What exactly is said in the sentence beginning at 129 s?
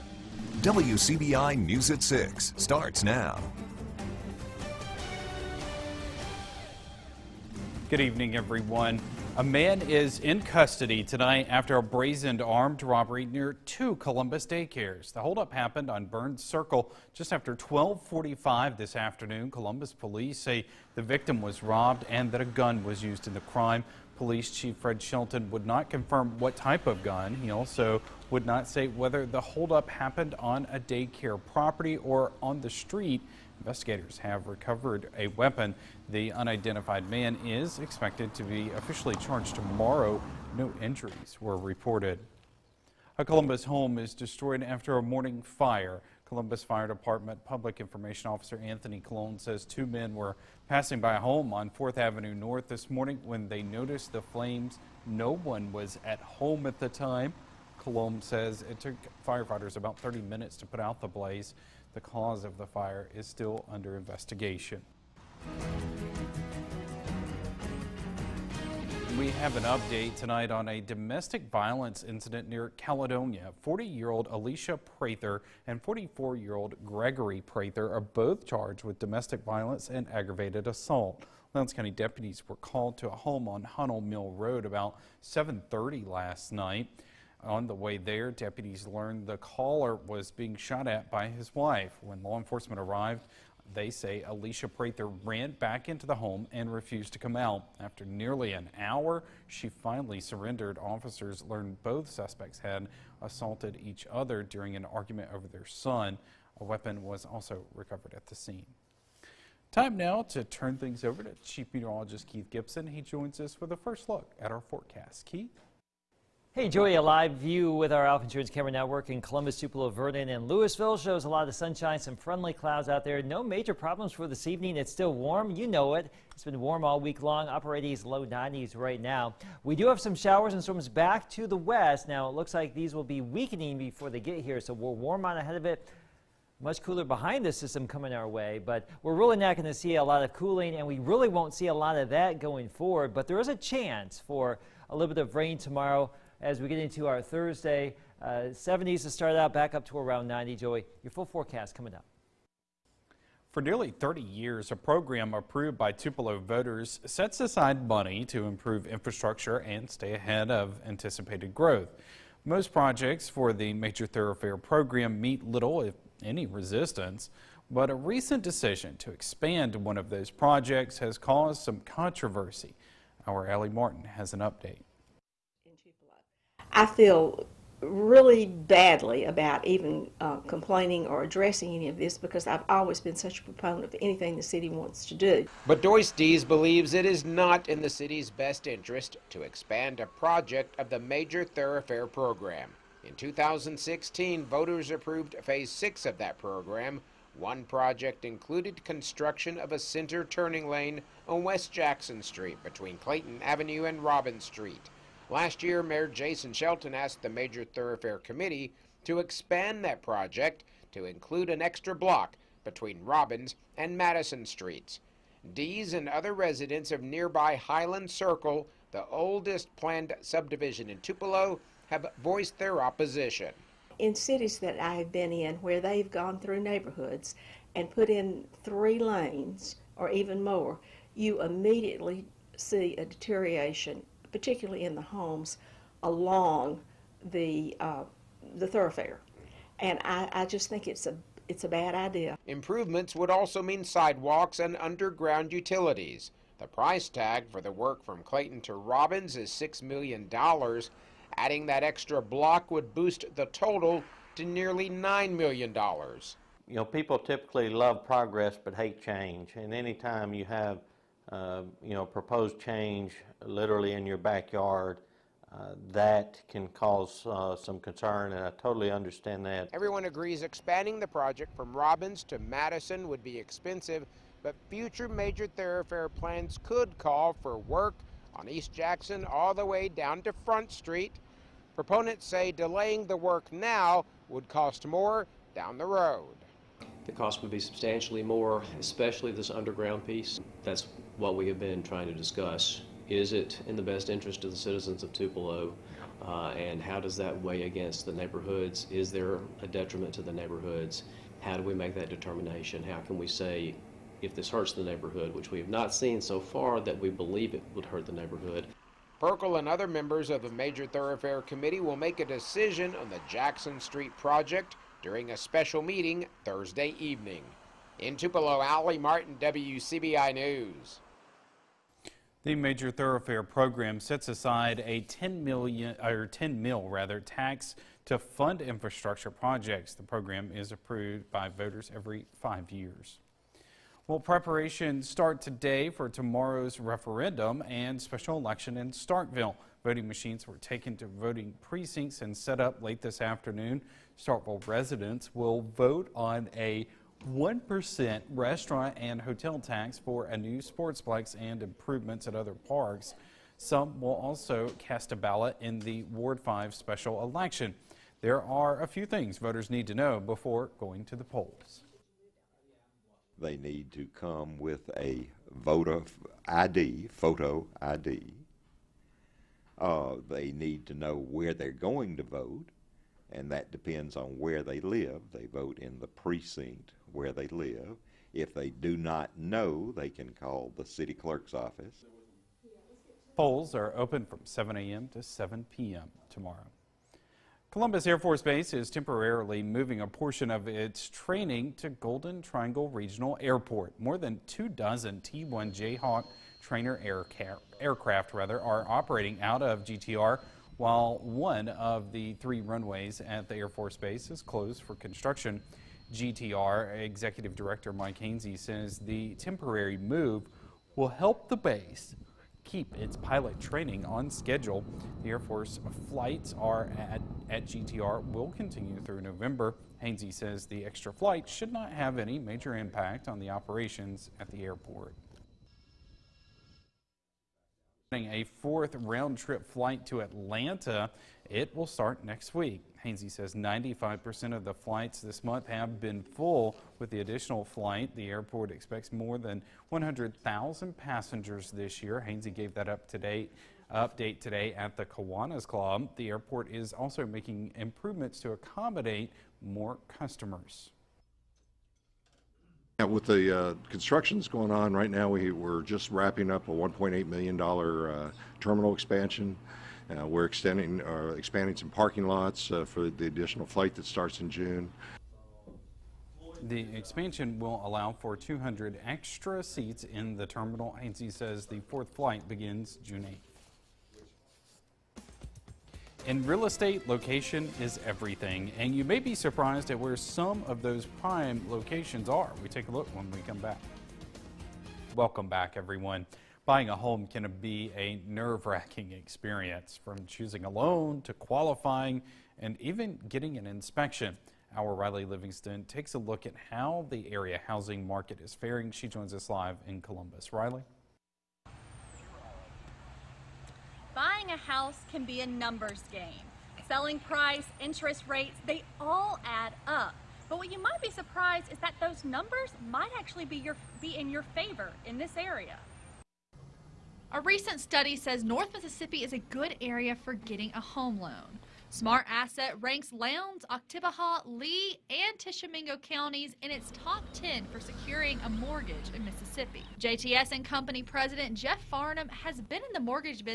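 We do have some showers and storms back to the west.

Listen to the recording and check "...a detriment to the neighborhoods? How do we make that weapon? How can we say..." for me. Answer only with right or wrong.
wrong.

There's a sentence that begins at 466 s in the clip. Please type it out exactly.
The expansion will allow for 200 extra seats in the terminal as says the fourth flight begins June 8th.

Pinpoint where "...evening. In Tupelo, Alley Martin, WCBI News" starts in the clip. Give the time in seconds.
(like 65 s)
316 s.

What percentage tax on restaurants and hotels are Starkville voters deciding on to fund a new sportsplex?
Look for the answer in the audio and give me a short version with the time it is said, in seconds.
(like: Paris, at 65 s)
1%, at 347 s.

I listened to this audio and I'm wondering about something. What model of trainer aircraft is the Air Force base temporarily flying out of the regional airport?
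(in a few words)
T-1 Jayhawk.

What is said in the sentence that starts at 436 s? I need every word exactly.
With the additional flight, the airport expects more than 100,000 passengers this year.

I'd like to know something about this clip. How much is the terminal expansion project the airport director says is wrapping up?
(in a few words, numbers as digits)
$1.8 million.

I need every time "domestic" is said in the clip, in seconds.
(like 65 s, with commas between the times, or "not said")
70 s, 78 s.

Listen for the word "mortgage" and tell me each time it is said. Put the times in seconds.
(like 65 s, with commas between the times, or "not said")
528 s, 532 s.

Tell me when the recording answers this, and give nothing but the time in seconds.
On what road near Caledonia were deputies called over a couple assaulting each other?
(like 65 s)
83 s.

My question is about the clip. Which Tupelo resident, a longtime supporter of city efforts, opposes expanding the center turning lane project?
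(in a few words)
Doyce Dees.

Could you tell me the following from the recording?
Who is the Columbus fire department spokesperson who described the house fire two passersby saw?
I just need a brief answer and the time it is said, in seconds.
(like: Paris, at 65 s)
Anthony Colon, at 48 s.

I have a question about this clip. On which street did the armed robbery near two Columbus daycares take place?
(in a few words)
Burns Circle.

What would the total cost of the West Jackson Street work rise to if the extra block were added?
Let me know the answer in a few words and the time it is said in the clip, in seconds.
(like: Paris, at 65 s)
nearly $9 million, at 254 s.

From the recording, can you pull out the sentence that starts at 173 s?
Our Ellie Martin has an update.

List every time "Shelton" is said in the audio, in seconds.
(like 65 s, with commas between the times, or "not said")
25 s, 206 s.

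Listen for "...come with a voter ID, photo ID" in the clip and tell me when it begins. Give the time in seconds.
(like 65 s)
364 s.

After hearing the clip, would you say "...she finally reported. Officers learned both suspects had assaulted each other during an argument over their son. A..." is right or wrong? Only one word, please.
wrong.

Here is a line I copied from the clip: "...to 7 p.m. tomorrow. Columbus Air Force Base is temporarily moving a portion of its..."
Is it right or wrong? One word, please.
right.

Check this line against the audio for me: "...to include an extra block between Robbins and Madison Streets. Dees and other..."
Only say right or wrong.
right.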